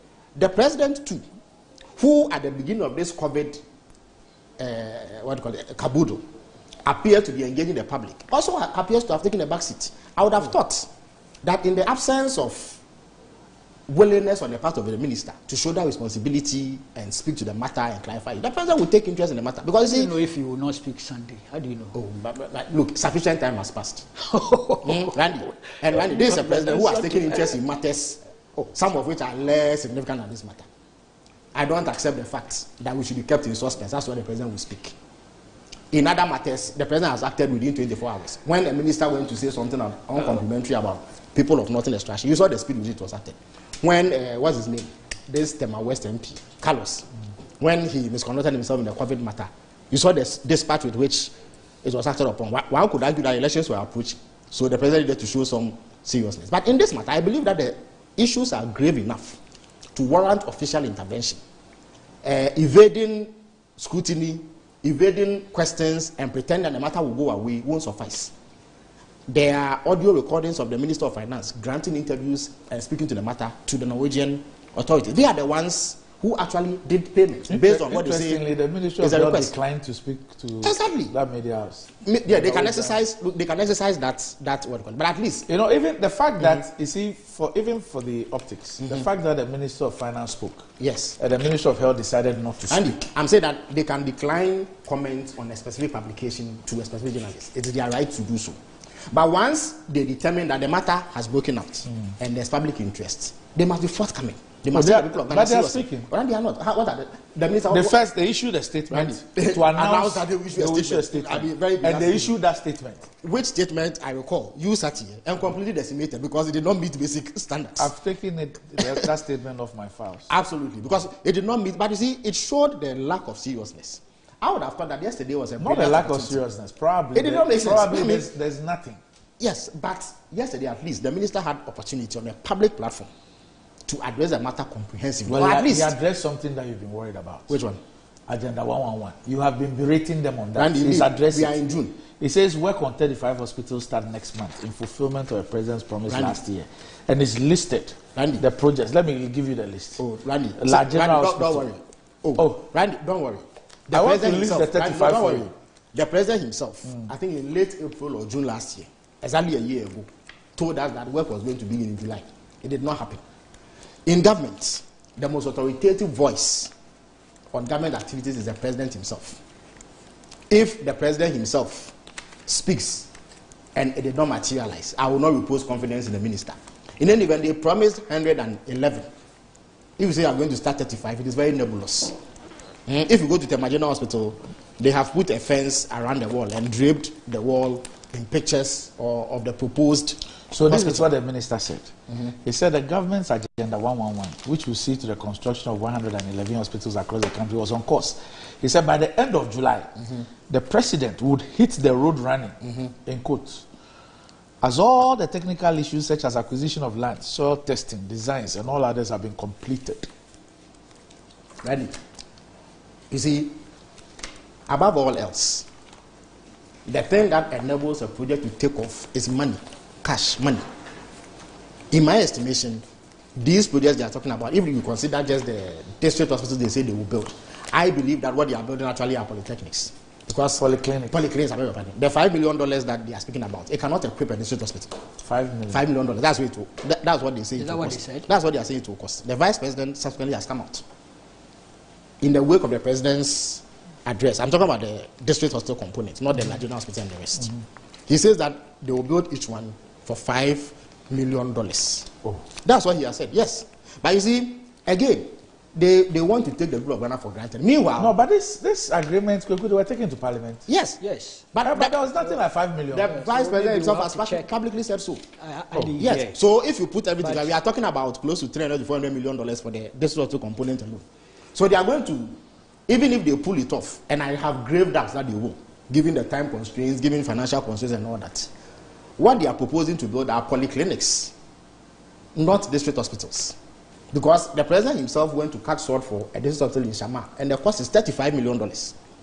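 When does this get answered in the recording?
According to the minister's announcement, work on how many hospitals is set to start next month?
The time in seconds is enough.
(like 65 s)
142 s.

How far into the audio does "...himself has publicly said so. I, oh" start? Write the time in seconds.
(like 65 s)
263 s.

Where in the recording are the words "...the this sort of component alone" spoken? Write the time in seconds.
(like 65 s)
269 s.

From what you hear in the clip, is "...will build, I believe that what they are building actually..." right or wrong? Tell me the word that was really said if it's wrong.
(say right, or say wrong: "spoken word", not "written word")
right.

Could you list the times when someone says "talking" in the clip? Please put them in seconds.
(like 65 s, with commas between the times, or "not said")
224 s, 244 s, 267 s.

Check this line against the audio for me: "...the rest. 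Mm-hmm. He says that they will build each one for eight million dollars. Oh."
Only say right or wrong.
wrong.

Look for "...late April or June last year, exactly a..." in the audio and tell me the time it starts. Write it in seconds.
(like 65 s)
157 s.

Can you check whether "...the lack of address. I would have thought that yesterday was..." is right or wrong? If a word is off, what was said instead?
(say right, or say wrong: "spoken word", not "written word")
wrong: "seriousness", not "address".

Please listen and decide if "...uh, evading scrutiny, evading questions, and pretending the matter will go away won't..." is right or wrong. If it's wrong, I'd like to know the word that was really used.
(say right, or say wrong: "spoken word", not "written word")
right.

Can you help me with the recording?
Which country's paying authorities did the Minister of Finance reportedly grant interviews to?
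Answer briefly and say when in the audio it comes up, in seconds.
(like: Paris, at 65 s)
Norwegian, at 73 s.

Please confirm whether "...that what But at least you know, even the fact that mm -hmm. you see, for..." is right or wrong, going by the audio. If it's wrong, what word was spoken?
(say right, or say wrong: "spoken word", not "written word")
right.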